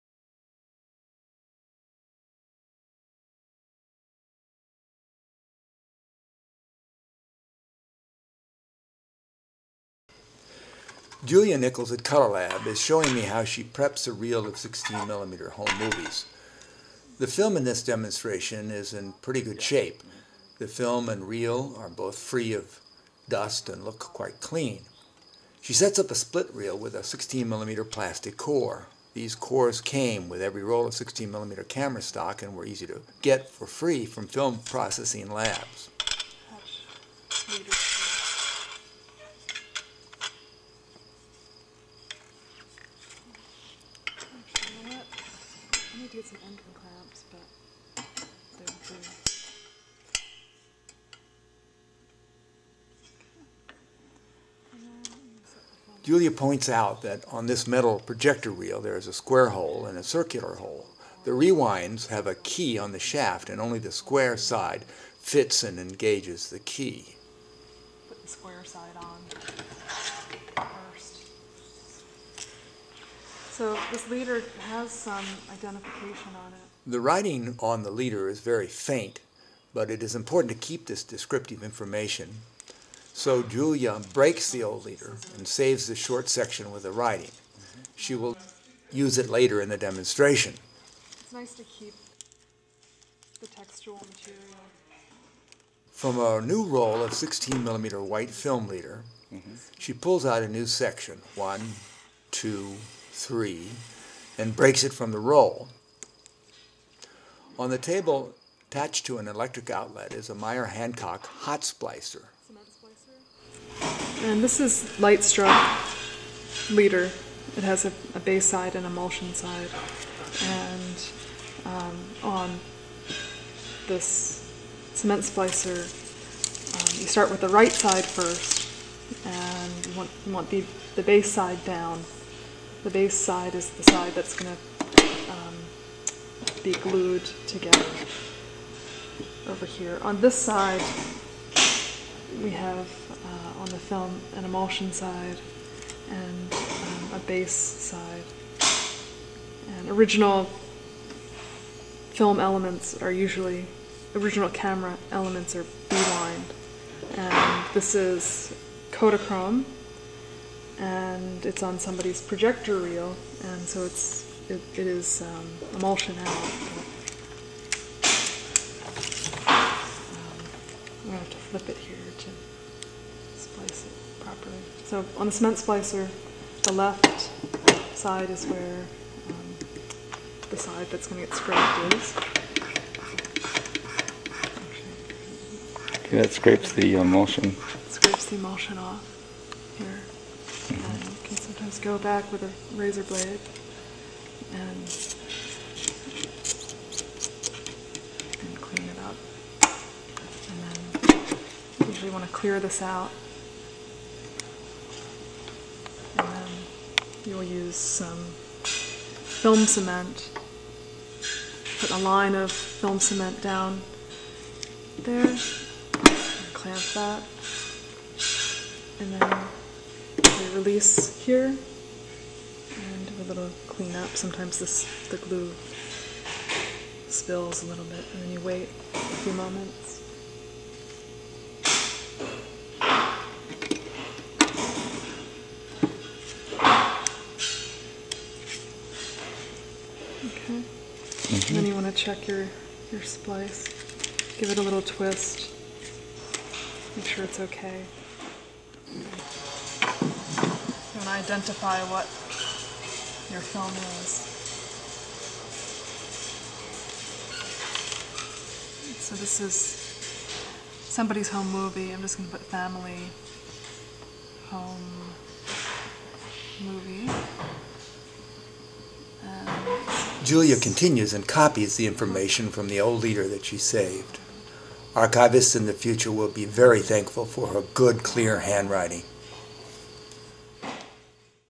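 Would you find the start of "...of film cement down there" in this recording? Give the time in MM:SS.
03:32.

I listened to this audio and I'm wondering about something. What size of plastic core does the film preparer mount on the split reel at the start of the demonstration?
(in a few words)
16mm.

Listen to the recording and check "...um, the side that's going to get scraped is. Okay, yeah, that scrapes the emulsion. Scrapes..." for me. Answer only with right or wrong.
right.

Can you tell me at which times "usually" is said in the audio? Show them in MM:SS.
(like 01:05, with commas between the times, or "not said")
02:33, 03:21.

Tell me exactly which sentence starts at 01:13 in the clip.
So this leader has some identification on it.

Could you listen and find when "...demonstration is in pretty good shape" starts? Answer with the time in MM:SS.
00:17.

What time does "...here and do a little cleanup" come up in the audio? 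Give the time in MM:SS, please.
03:41.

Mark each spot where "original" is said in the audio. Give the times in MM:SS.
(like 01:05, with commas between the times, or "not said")
02:29, 02:34.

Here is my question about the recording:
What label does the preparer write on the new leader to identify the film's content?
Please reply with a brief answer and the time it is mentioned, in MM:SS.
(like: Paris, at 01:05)
family home movie, at 04:22.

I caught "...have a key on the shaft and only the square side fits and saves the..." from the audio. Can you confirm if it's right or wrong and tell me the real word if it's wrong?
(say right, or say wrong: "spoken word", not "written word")
wrong: "engages", not "saves".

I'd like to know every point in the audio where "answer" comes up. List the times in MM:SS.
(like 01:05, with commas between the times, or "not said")
not said.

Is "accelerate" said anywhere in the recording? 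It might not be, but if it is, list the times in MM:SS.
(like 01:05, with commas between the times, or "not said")
not said.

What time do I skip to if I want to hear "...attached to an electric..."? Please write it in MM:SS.
01:48.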